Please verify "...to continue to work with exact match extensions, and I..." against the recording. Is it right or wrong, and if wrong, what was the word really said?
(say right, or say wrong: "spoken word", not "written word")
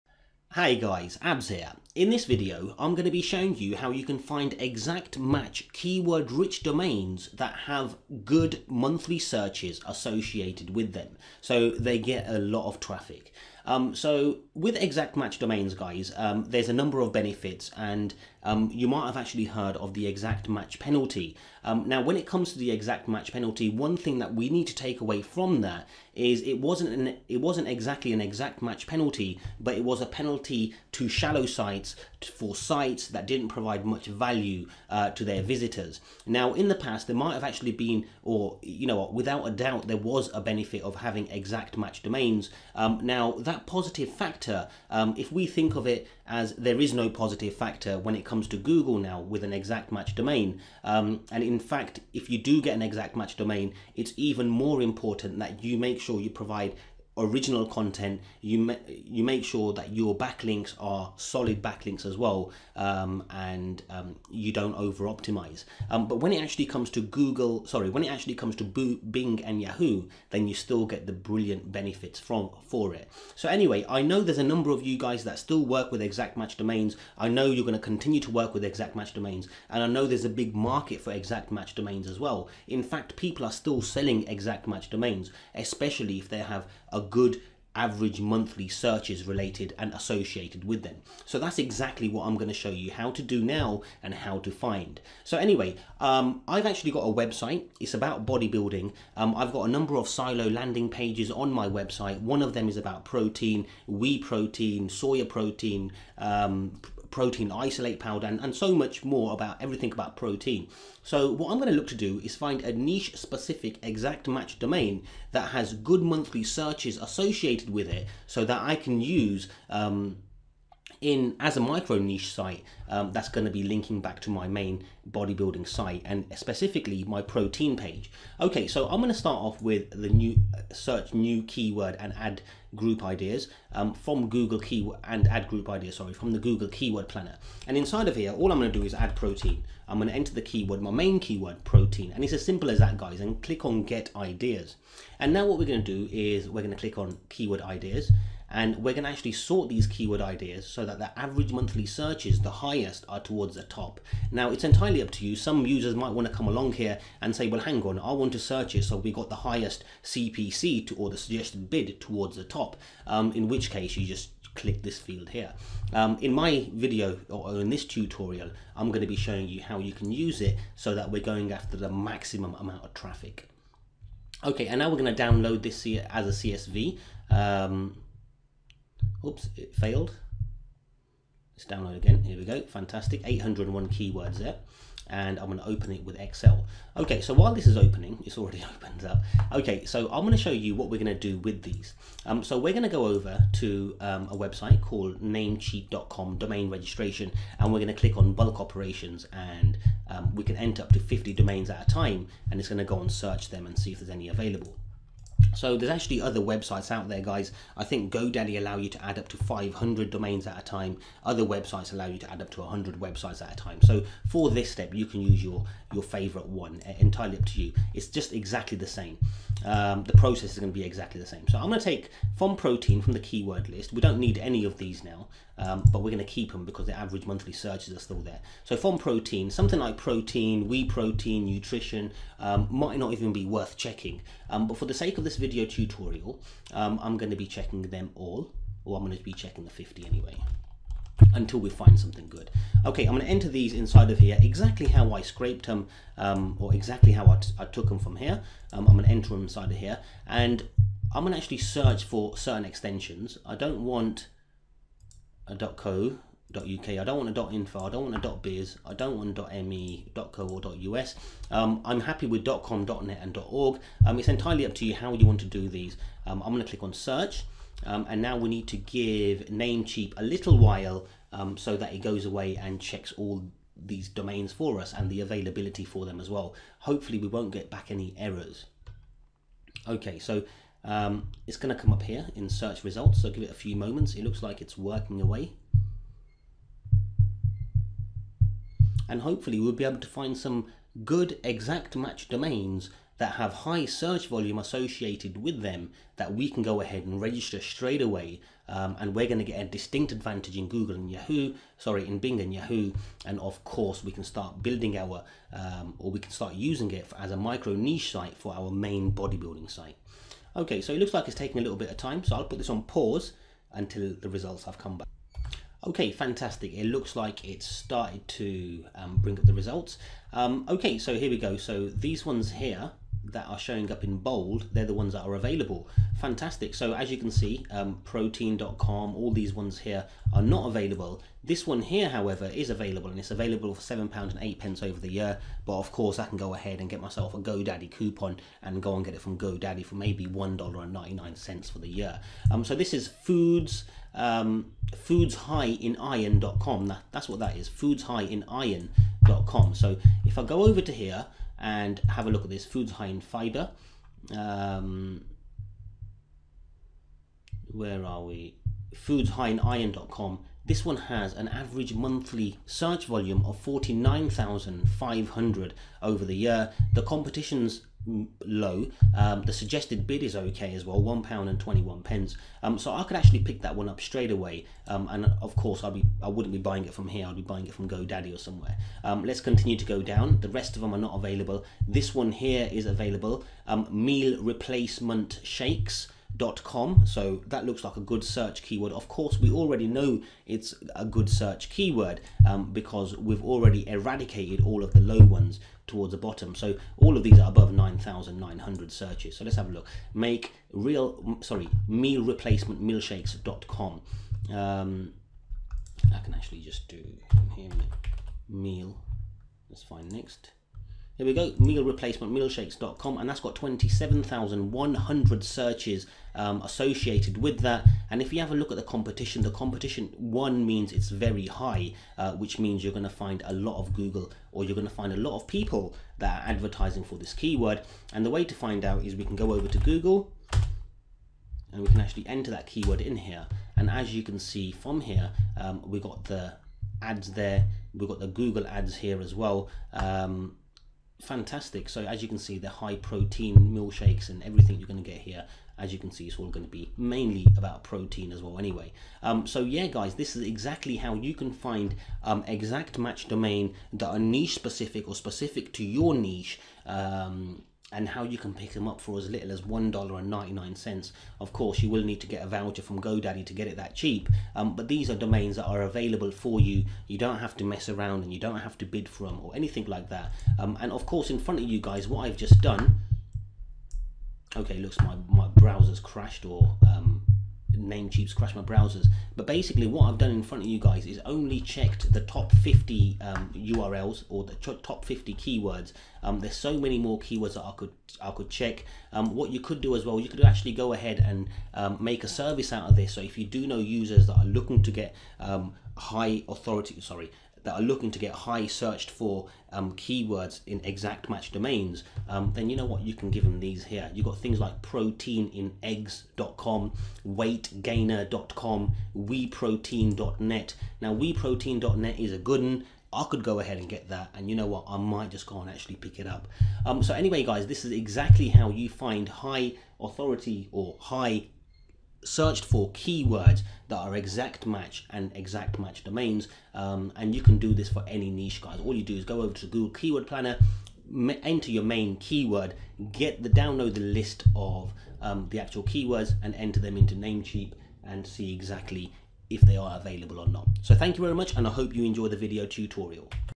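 wrong: "domains", not "extensions".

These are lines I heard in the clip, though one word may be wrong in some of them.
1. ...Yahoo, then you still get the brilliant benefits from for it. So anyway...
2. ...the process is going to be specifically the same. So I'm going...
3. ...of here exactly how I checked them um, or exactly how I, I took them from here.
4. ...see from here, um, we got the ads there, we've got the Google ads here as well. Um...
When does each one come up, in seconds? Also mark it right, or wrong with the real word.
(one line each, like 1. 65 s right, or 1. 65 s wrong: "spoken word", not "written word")
1. 69 s right
2. 220 s wrong: "exactly", not "specifically"
3. 244 s wrong: "scraped", not "checked"
4. 434 s right.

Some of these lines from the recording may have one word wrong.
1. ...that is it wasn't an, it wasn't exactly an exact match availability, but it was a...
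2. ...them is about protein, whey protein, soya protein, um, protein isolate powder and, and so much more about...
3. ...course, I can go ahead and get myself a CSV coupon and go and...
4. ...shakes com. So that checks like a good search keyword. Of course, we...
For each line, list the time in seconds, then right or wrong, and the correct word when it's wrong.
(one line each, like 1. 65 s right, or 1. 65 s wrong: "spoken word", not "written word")
1. 25 s wrong: "penalty", not "availability"
2. 102 s right
3. 335 s wrong: "GoDaddy", not "CSV"
4. 385 s wrong: "looks", not "checks".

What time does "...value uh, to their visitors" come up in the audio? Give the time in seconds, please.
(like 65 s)
34 s.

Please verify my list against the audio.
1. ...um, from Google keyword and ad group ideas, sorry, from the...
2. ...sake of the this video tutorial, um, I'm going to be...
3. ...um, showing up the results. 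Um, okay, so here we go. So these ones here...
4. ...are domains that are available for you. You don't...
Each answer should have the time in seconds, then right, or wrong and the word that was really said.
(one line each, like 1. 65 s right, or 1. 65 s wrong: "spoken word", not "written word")
1. 133 s right
2. 234 s right
3. 318 s wrong: "bring", not "showing"
4. 465 s right.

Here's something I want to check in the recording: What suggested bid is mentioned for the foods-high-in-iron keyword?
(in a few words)
£1.21.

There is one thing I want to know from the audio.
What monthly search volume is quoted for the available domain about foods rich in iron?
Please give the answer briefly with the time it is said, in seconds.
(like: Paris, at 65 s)
49,500, at 363 s.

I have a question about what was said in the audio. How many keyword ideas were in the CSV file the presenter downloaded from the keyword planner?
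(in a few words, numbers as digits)
801.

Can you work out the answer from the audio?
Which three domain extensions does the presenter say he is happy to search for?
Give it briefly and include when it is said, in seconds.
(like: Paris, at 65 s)
.com, .net and .org, at 262 s.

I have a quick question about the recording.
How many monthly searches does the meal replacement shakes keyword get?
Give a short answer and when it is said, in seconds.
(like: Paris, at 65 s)
27,100, at 413 s.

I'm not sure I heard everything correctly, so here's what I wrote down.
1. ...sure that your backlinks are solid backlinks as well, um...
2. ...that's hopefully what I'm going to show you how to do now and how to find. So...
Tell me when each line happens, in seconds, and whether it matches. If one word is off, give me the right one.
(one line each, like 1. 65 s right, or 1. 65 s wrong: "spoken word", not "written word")
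1. 59 s right
2. 91 s wrong: "exactly", not "hopefully".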